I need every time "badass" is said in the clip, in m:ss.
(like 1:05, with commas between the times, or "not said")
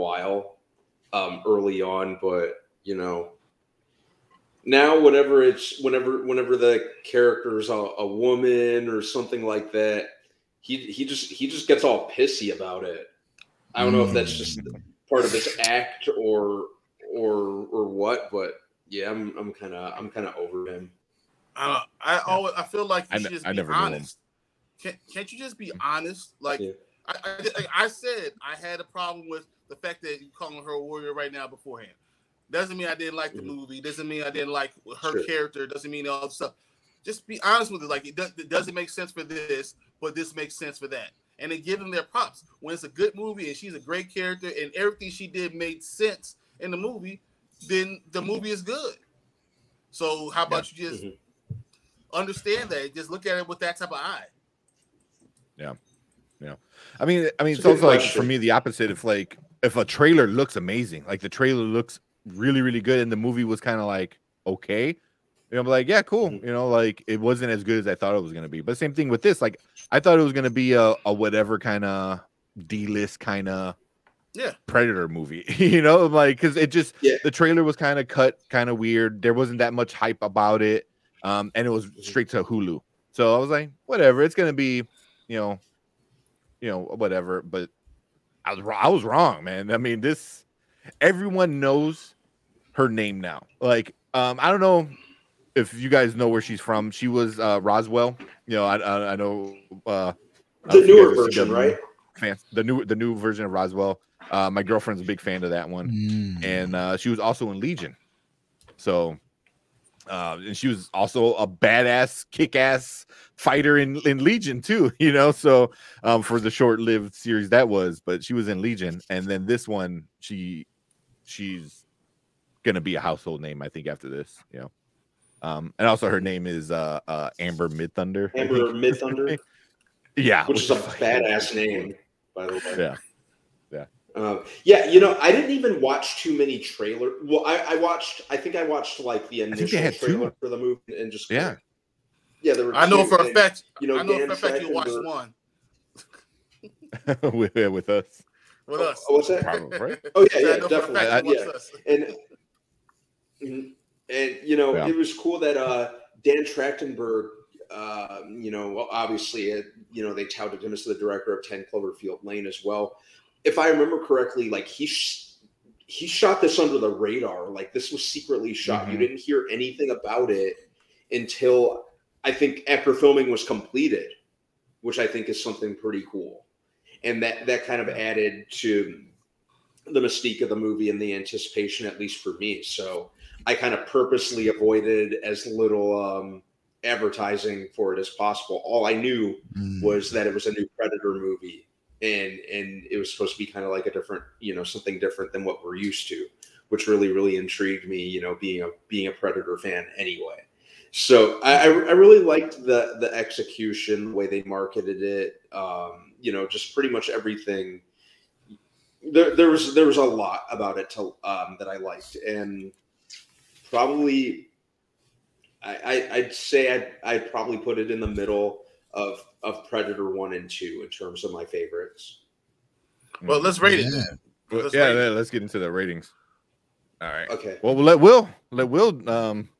1:51, 2:10.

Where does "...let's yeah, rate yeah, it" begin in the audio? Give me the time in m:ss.
3:44.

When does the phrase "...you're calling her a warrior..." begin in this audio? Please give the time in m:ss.
0:30.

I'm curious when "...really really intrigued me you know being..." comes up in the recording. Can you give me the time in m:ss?
3:16.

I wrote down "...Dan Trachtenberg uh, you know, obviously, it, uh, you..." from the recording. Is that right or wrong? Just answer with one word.
right.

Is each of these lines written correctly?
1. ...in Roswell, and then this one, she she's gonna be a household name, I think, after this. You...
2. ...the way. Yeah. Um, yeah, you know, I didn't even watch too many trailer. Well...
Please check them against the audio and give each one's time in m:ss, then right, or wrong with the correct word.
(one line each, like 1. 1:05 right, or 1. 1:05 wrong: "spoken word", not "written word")
1. 1:58 wrong: "Legion", not "Roswell"
2. 2:12 right.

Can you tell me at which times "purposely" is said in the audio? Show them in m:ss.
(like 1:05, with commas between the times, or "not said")
3:03.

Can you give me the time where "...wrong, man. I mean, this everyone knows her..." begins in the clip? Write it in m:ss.
1:29.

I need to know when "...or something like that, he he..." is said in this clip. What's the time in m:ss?
0:08.